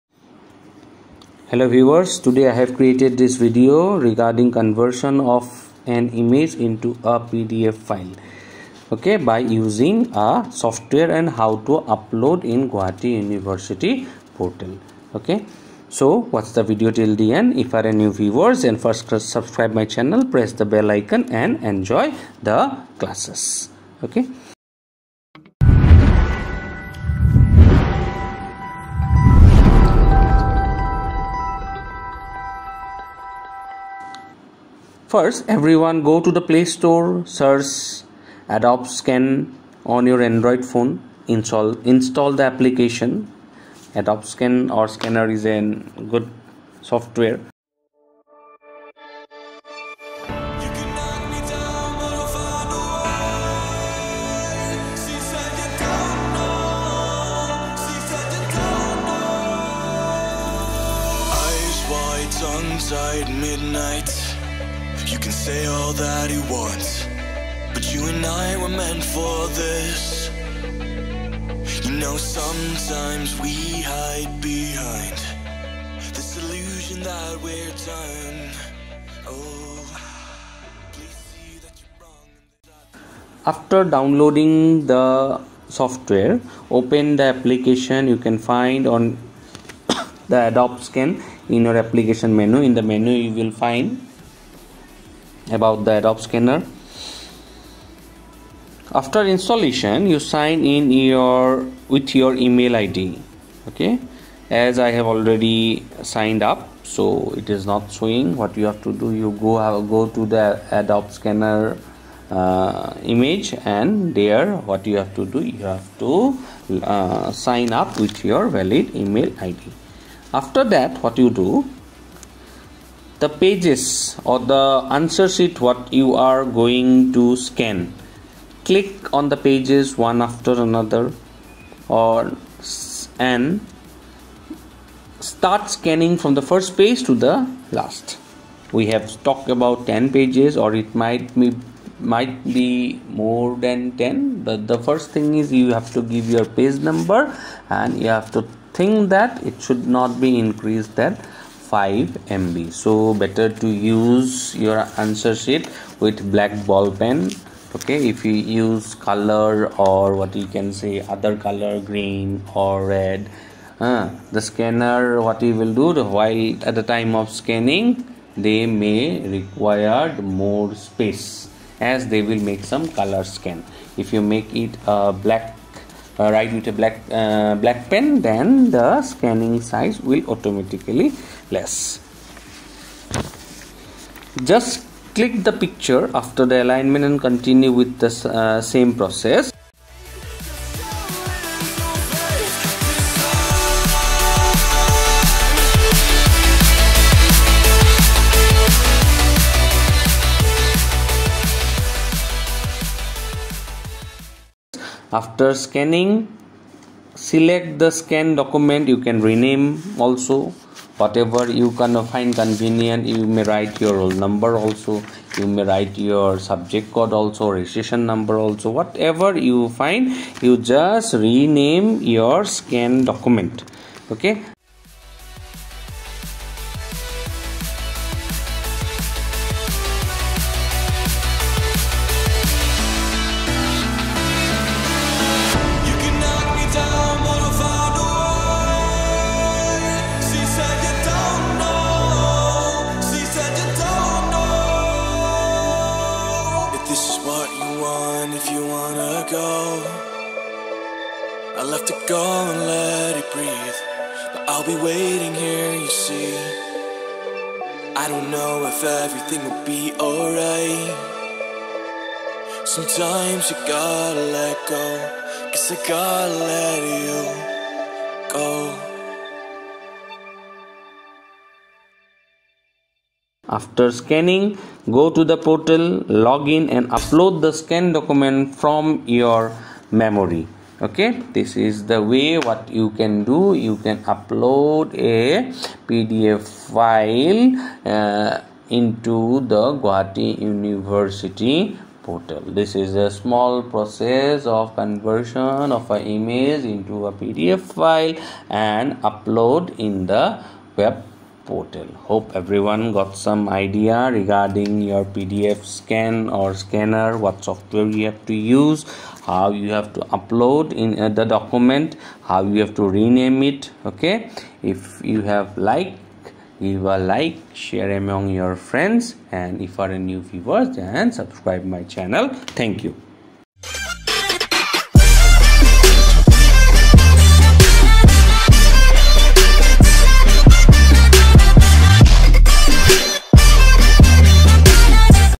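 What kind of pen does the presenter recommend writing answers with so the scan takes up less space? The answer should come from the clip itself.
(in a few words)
black ball pen.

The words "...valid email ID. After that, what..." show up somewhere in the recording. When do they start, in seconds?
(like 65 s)
118 s.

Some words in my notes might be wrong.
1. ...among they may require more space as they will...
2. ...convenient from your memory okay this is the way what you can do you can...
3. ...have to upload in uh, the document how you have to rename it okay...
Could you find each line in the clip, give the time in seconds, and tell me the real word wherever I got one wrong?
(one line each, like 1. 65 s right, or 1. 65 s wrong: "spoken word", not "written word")
1. 167 s wrong: "scanning", not "among"
2. 277 s wrong: "document", not "convenient"
3. 309 s right.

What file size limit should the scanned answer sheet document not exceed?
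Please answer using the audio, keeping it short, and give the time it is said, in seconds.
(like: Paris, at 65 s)
5 MB, at 151 s.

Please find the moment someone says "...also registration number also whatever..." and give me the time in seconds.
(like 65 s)
217 s.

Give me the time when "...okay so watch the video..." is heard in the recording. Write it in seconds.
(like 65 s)
15 s.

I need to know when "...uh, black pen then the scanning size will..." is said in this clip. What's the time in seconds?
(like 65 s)
177 s.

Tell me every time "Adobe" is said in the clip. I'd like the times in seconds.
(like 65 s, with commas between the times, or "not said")
38 s, 43 s, 90 s, 95 s, 110 s.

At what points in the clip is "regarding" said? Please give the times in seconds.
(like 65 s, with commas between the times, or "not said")
4 s, 304 s.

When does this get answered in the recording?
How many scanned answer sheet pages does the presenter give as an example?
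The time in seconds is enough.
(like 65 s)
139 s.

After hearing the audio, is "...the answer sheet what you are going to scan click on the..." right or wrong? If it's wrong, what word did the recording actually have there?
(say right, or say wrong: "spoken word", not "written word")
right.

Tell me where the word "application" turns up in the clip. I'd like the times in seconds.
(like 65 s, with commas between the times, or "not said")
42 s, 87 s, 91 s.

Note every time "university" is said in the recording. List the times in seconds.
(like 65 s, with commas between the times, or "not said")
13 s, 290 s.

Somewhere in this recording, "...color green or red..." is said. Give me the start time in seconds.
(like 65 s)
161 s.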